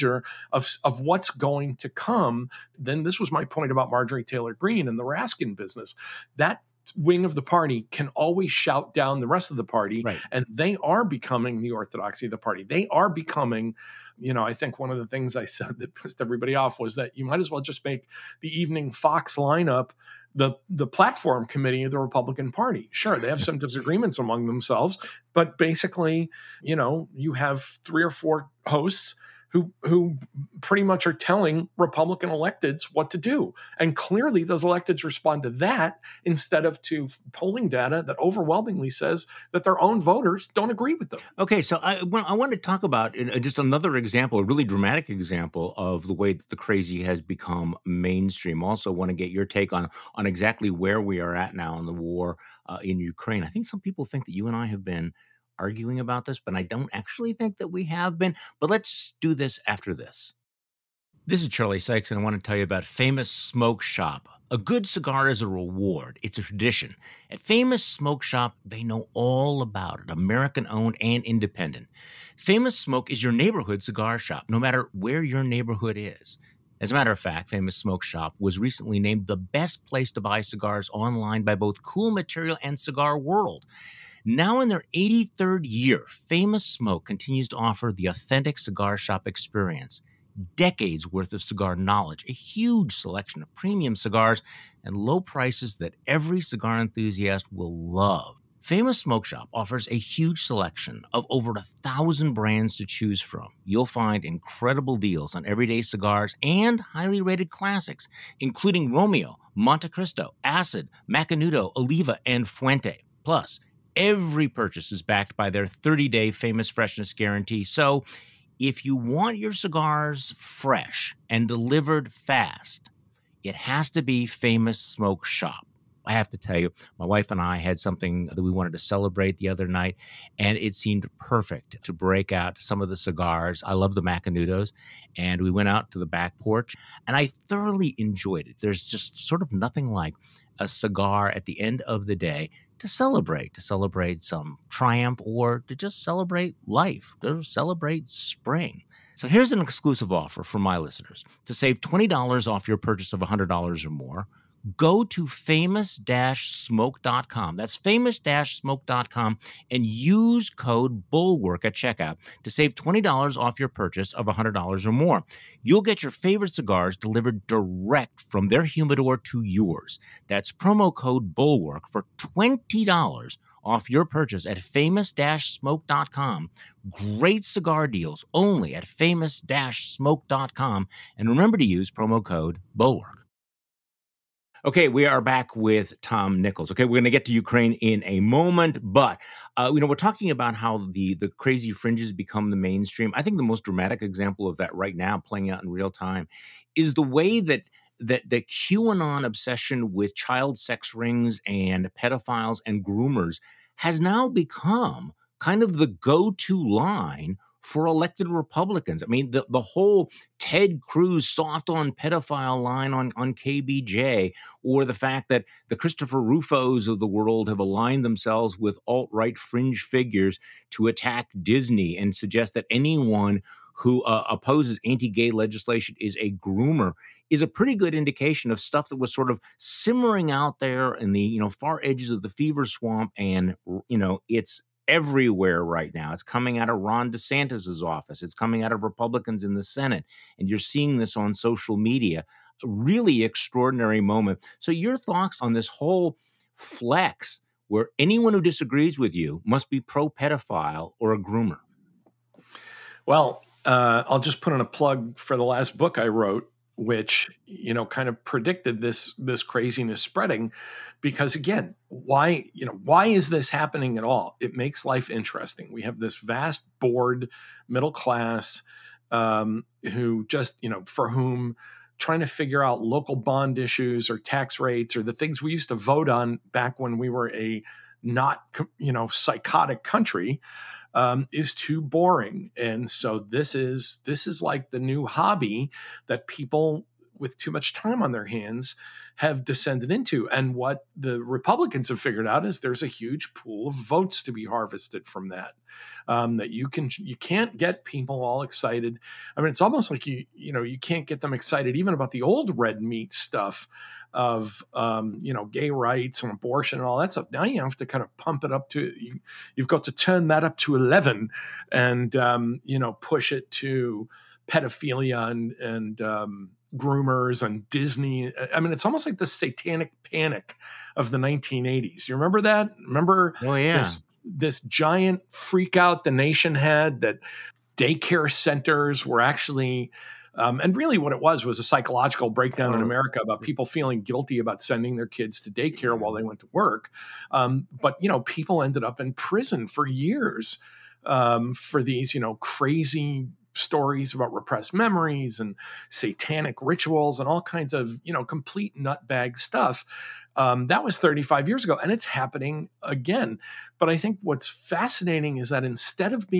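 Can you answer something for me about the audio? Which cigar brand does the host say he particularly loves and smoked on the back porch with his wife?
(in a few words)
Macanudo.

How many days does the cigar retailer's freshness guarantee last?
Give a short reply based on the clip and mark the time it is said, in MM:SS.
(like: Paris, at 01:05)
30, at 01:55.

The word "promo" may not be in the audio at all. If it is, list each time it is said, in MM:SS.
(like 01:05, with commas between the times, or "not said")
02:50, 03:01.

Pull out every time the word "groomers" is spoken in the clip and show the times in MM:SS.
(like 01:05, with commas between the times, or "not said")
03:22, 03:46, 04:11, 05:16.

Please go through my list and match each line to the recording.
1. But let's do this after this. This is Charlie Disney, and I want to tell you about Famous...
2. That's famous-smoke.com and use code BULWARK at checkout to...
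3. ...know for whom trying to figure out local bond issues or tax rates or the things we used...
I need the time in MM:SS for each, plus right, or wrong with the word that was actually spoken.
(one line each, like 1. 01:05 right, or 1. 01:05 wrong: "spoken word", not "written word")
1. 00:58 wrong: "Sykes", not "Disney"
2. 02:37 right
3. 04:30 right.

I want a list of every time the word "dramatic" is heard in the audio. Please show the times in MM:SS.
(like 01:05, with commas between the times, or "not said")
00:44, 03:13.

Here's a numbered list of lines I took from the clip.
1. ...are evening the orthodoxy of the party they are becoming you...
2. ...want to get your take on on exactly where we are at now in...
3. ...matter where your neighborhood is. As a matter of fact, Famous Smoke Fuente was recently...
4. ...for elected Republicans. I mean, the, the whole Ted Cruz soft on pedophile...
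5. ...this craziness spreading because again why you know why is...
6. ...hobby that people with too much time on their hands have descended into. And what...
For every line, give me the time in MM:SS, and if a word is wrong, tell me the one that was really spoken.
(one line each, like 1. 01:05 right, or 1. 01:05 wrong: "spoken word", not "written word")
1. 00:10 wrong: "becoming", not "evening"
2. 00:48 right
3. 01:14 wrong: "Shop", not "Fuente"
4. 03:27 right
5. 04:19 right
6. 04:45 right.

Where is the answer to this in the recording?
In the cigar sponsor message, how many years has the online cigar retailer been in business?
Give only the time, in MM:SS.
01:24.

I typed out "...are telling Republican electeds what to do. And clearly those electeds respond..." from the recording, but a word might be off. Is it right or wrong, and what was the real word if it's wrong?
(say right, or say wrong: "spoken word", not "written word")
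right.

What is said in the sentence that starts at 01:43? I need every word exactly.
You'll find incredible deals on everyday cigars and highly rated classics, including Romeo, Monte Cristo, Acid, Macanudo, Oliva, and Fuente.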